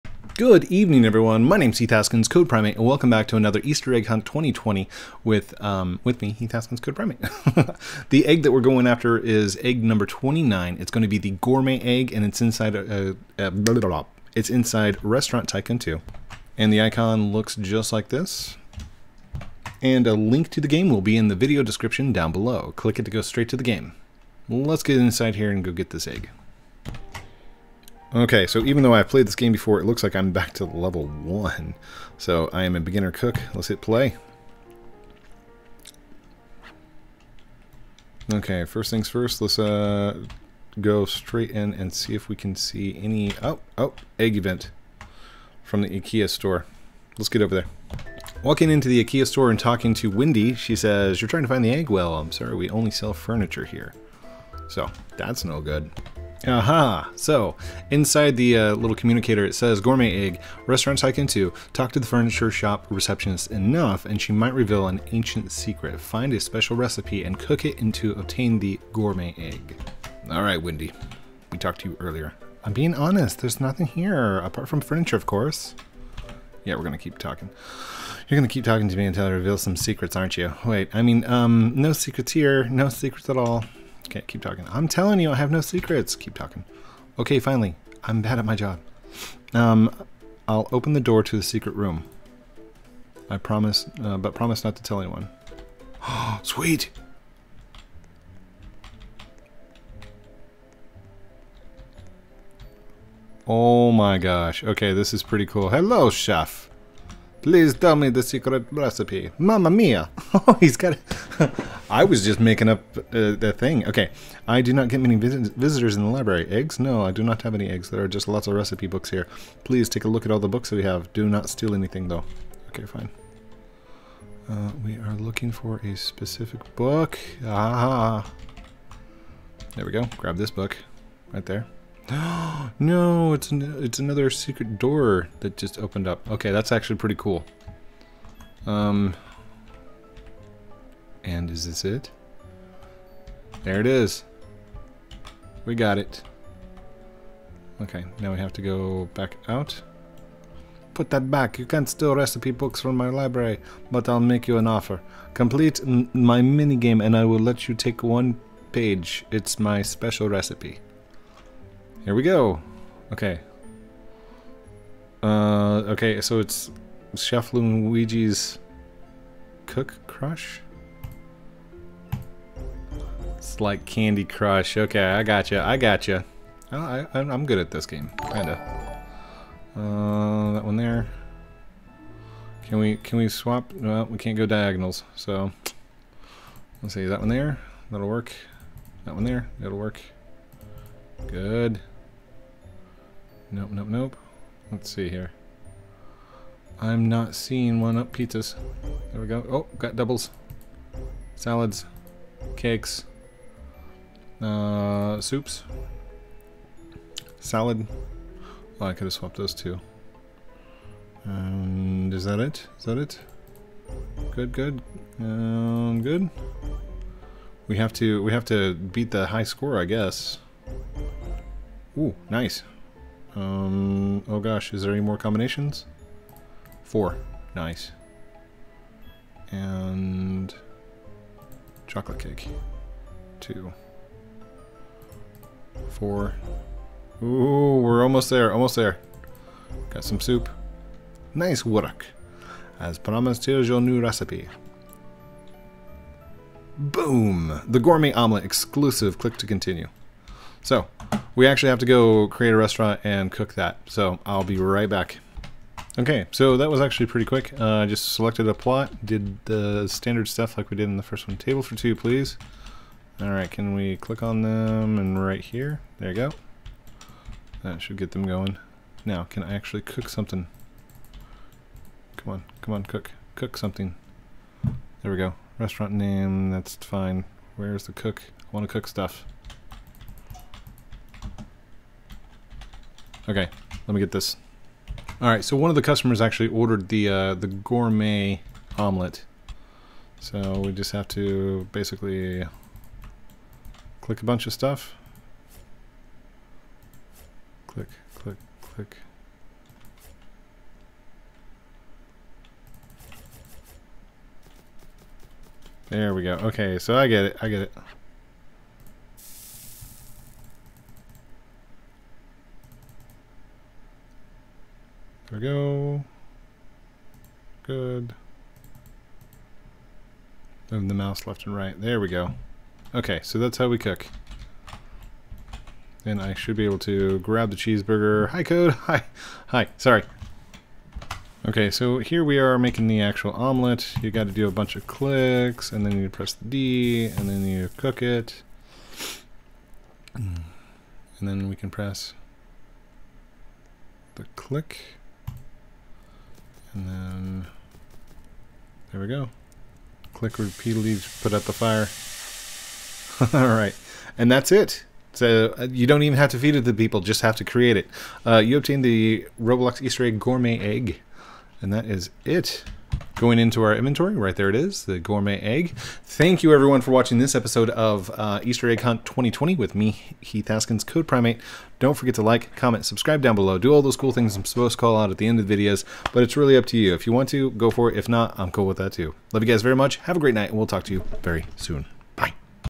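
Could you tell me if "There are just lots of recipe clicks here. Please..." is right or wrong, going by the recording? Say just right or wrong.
wrong.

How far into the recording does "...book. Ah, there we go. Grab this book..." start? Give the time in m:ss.
2:06.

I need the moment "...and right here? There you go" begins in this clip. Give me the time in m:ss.
4:24.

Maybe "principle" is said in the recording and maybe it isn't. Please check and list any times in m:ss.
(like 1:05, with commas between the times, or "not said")
not said.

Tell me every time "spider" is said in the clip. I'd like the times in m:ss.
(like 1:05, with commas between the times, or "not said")
not said.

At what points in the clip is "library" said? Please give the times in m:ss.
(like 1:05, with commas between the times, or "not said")
1:56, 2:33.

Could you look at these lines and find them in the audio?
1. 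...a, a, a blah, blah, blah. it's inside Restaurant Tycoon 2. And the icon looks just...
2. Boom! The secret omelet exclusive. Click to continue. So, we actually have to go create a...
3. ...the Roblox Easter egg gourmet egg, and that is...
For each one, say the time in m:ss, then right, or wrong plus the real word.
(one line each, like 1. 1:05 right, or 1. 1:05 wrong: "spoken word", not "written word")
1. 0:12 right
2. 4:06 wrong: "gourmet", not "secret"
3. 5:58 right.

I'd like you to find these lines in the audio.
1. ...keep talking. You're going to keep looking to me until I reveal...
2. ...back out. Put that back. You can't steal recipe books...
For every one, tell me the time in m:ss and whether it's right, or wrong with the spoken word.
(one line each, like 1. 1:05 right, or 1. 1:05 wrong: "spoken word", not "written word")
1. 1:16 wrong: "talking", not "looking"
2. 2:29 right.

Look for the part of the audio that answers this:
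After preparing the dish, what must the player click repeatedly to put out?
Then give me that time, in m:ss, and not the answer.
5:51.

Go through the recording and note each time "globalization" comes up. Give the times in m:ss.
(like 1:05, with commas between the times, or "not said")
not said.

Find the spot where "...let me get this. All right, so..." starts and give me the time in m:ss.
4:43.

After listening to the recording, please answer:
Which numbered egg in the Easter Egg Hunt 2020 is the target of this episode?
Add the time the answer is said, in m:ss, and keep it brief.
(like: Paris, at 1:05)
29, at 0:09.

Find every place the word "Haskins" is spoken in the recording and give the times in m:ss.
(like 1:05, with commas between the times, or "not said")
0:01, 0:06, 6:10.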